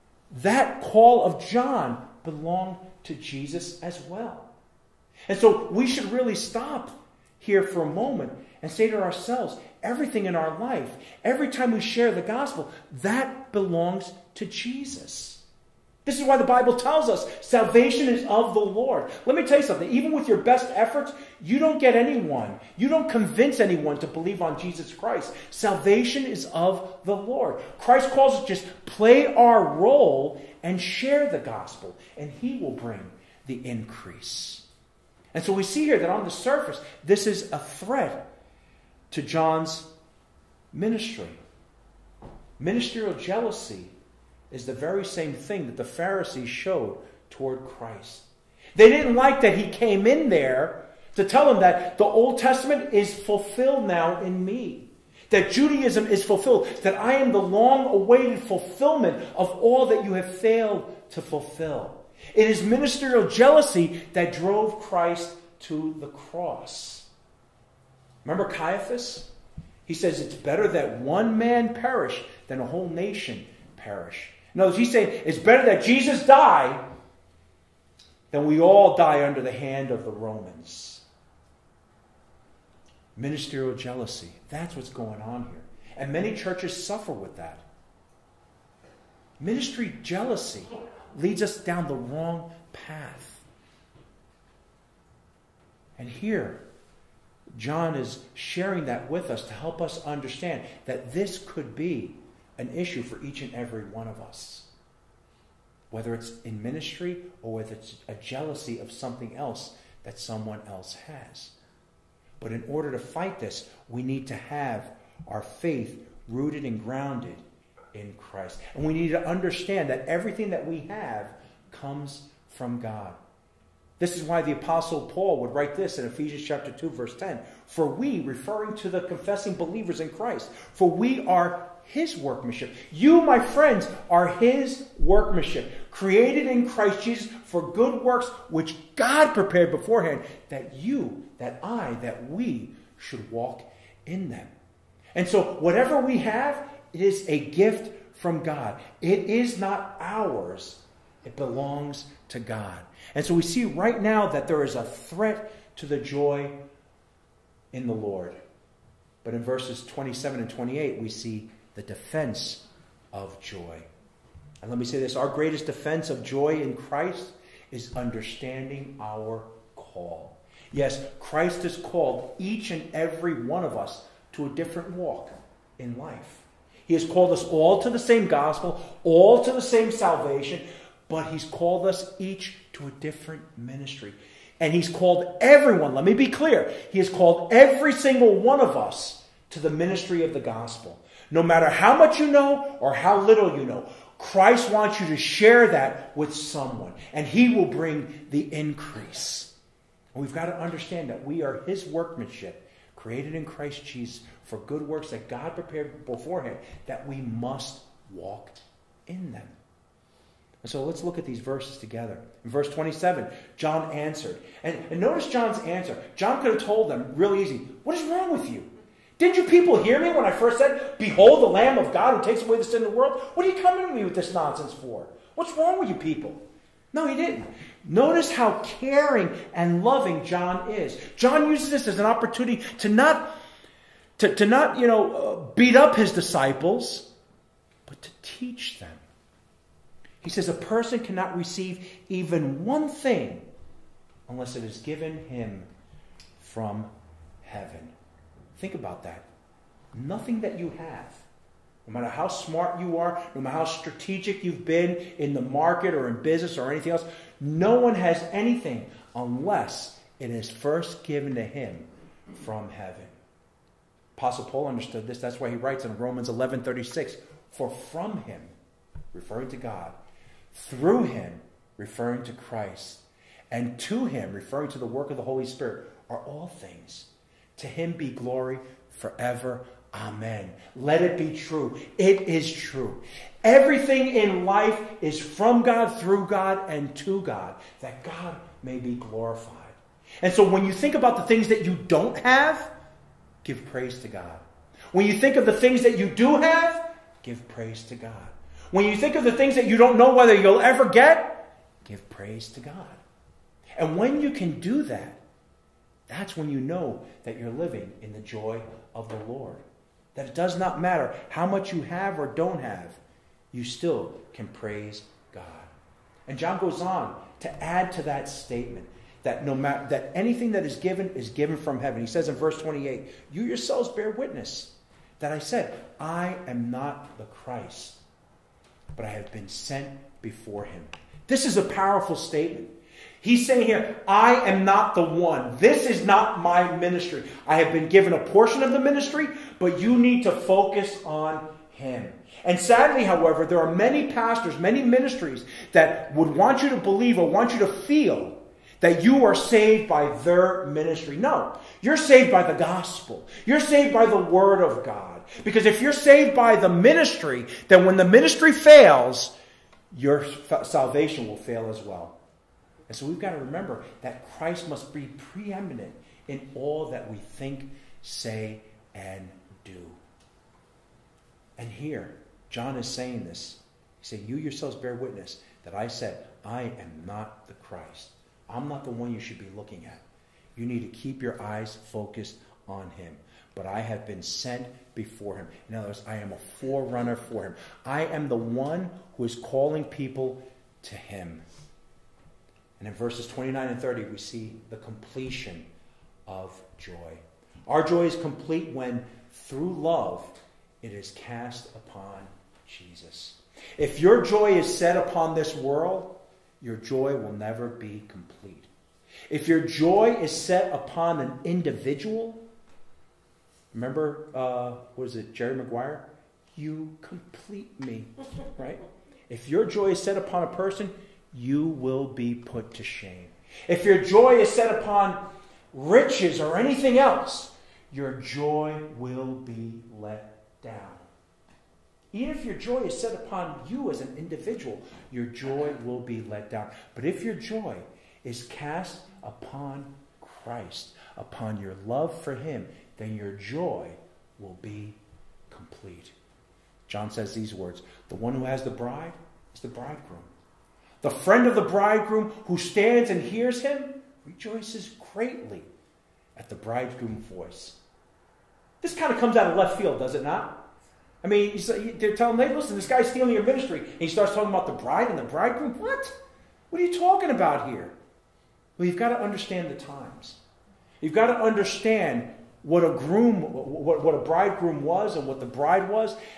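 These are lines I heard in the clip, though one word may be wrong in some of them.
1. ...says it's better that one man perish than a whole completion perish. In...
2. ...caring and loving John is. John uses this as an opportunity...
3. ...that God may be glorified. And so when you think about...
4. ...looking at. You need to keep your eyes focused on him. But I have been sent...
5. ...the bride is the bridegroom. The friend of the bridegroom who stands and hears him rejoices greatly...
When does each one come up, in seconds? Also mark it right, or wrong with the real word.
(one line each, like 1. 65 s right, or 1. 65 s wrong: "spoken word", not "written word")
1. 69 s wrong: "nation", not "completion"
2. 228 s right
3. 287 s right
4. 379 s right
5. 448 s right.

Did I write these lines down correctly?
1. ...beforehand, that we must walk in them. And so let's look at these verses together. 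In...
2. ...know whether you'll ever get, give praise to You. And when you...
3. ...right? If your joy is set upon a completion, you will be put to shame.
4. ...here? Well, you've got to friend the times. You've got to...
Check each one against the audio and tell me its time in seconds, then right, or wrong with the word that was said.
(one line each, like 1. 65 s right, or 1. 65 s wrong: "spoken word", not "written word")
1. 206 s right
2. 299 s wrong: "God", not "You"
3. 418 s wrong: "person", not "completion"
4. 467 s wrong: "understand", not "friend".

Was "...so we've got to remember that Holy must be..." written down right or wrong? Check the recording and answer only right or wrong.
wrong.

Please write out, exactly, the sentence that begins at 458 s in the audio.
This kind of comes out of left field, does it not?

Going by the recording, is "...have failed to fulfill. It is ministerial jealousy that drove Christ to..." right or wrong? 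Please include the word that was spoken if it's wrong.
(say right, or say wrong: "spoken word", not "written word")
right.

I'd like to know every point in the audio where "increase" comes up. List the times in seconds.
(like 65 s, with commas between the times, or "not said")
33 s, 198 s.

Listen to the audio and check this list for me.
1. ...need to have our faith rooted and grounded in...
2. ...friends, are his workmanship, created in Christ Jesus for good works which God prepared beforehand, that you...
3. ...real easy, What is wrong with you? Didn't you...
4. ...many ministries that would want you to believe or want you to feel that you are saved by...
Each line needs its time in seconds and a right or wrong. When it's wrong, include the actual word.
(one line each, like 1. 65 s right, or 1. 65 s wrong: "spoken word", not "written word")
1. 114 s right
2. 133 s right
3. 217 s right
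4. 344 s right.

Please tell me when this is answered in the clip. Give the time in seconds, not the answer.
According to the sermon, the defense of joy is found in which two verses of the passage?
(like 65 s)
159 s.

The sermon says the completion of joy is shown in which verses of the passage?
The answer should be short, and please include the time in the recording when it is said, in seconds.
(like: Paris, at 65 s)
29 and 30, at 393 s.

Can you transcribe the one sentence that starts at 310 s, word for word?
That it does not matter how much you have or don't have, you still can praise God.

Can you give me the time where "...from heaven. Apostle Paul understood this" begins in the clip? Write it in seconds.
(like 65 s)
262 s.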